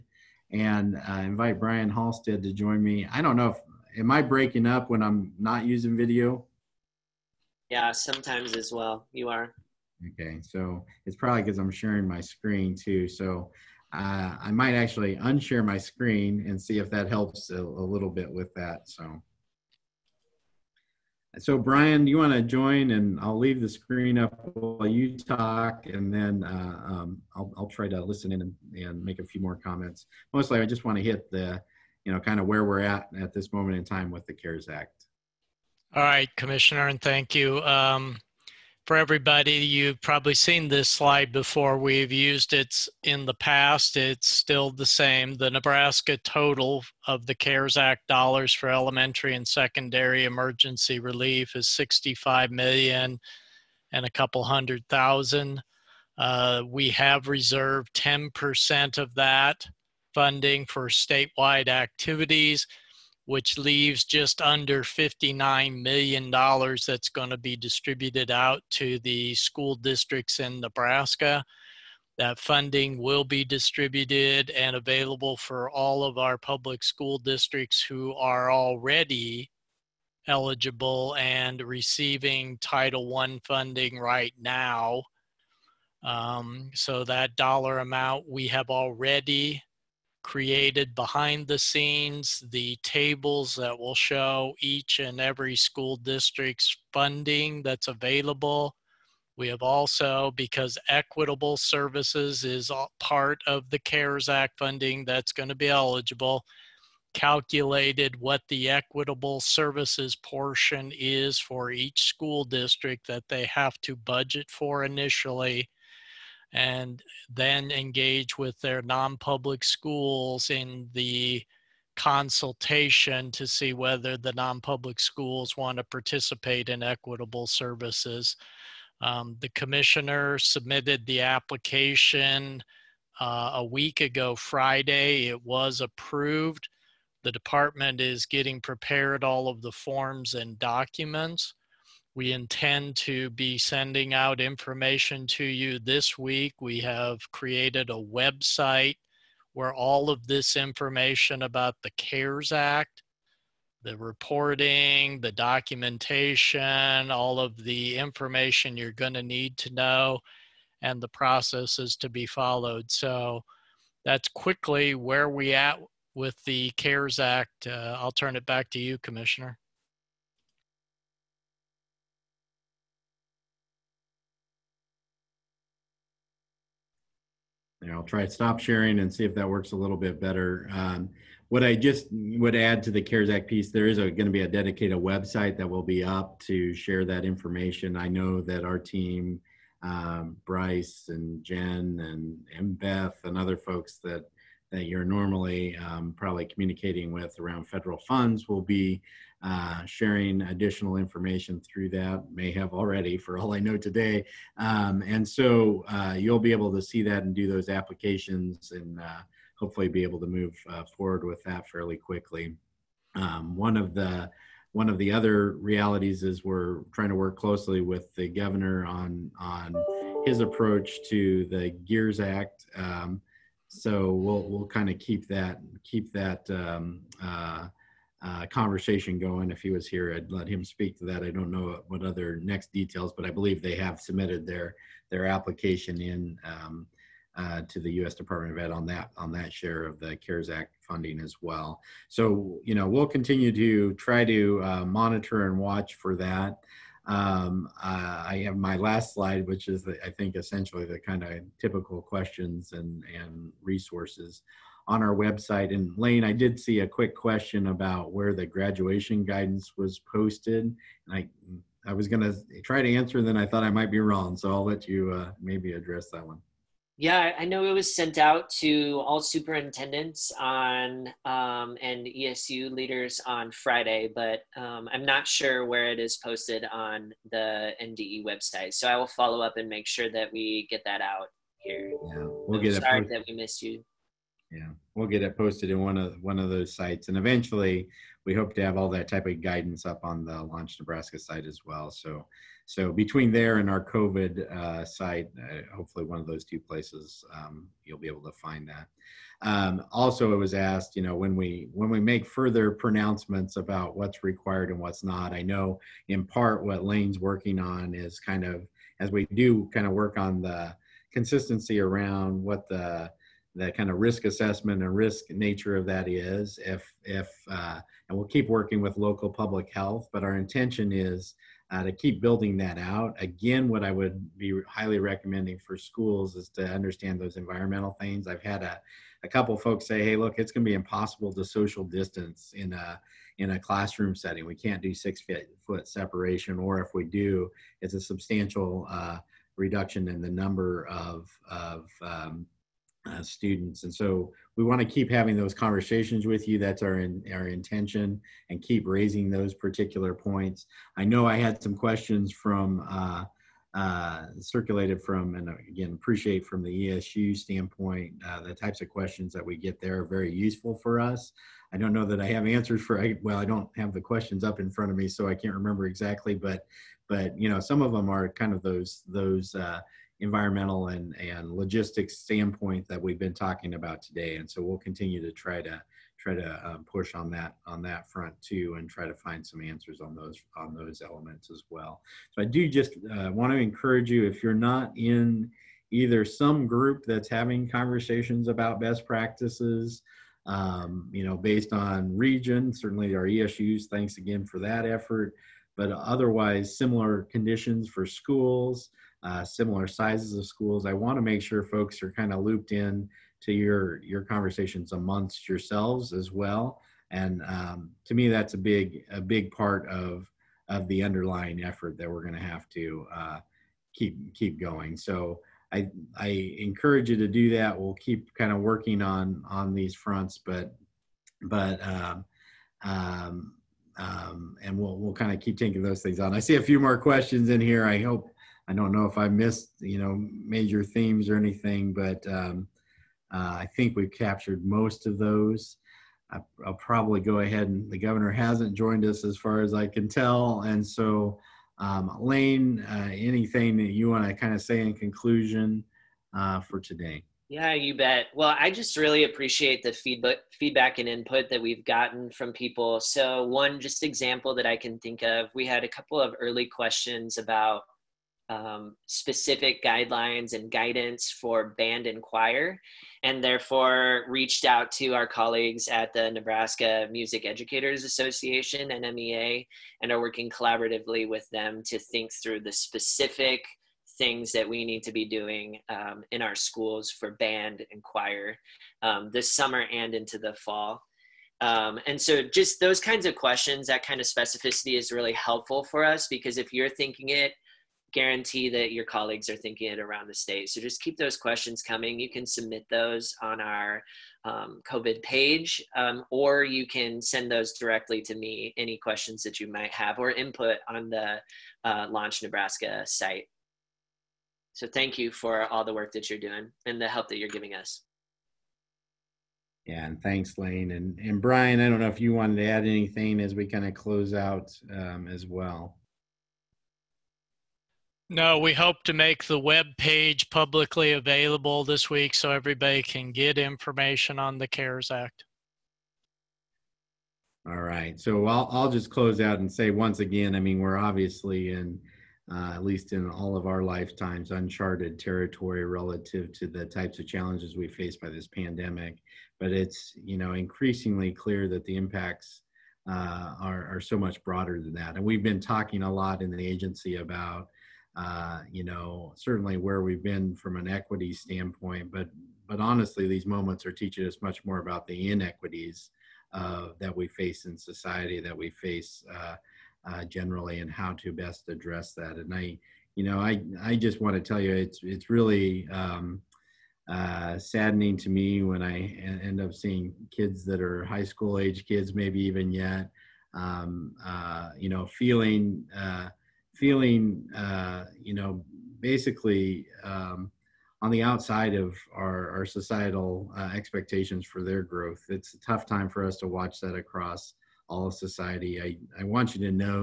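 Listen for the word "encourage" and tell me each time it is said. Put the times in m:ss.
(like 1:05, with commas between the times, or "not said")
6:23, 6:56.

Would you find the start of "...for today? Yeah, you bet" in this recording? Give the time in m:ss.
7:26.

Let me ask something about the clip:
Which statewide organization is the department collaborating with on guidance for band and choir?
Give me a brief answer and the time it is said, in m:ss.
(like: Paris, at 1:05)
Nebraska Music Educators Association, at 7:46.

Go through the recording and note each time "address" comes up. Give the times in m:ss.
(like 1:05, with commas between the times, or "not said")
4:25, 9:21.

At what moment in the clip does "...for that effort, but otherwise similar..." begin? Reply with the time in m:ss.
6:34.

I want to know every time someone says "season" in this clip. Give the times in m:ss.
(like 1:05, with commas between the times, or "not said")
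not said.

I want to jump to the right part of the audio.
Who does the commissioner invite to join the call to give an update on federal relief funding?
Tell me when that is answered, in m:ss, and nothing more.
0:01.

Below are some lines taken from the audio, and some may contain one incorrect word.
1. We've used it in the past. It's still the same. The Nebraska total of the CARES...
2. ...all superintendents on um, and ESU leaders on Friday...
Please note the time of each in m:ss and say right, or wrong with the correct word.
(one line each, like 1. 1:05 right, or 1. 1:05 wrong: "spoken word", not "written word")
1. 0:41 right
2. 4:29 right.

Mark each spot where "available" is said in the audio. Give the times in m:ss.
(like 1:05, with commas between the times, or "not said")
1:14, 1:37, 8:41.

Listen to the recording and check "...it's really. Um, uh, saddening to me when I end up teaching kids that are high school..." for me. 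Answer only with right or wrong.
wrong.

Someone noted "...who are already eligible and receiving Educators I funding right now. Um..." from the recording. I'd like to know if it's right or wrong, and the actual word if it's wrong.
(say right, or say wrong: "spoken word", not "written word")
wrong: "Title", not "Educators".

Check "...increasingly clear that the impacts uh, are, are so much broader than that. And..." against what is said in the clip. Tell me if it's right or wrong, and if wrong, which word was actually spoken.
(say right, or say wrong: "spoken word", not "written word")
right.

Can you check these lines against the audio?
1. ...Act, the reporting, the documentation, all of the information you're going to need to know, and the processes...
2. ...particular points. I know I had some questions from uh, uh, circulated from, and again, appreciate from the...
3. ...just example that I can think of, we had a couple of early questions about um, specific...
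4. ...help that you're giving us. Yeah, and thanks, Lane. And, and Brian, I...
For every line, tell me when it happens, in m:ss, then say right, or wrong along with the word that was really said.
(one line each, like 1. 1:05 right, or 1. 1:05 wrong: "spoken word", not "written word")
1. 2:32 right
2. 5:49 right
3. 7:33 right
4. 8:27 right.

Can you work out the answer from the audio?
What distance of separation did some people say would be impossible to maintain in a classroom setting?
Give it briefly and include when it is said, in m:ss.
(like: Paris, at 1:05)
6 feet, at 5:34.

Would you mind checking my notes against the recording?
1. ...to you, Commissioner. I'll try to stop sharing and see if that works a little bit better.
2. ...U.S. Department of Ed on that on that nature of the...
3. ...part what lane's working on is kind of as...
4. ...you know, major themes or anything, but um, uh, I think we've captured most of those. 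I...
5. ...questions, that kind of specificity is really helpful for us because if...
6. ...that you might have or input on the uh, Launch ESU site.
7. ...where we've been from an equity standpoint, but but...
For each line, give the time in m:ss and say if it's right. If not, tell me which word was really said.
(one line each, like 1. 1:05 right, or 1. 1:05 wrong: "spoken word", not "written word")
1. 2:48 right
2. 3:57 wrong: "share", not "nature"
3. 5:06 right
4. 7:09 right
5. 8:03 right
6. 8:19 wrong: "Nebraska", not "ESU"
7. 9:09 right.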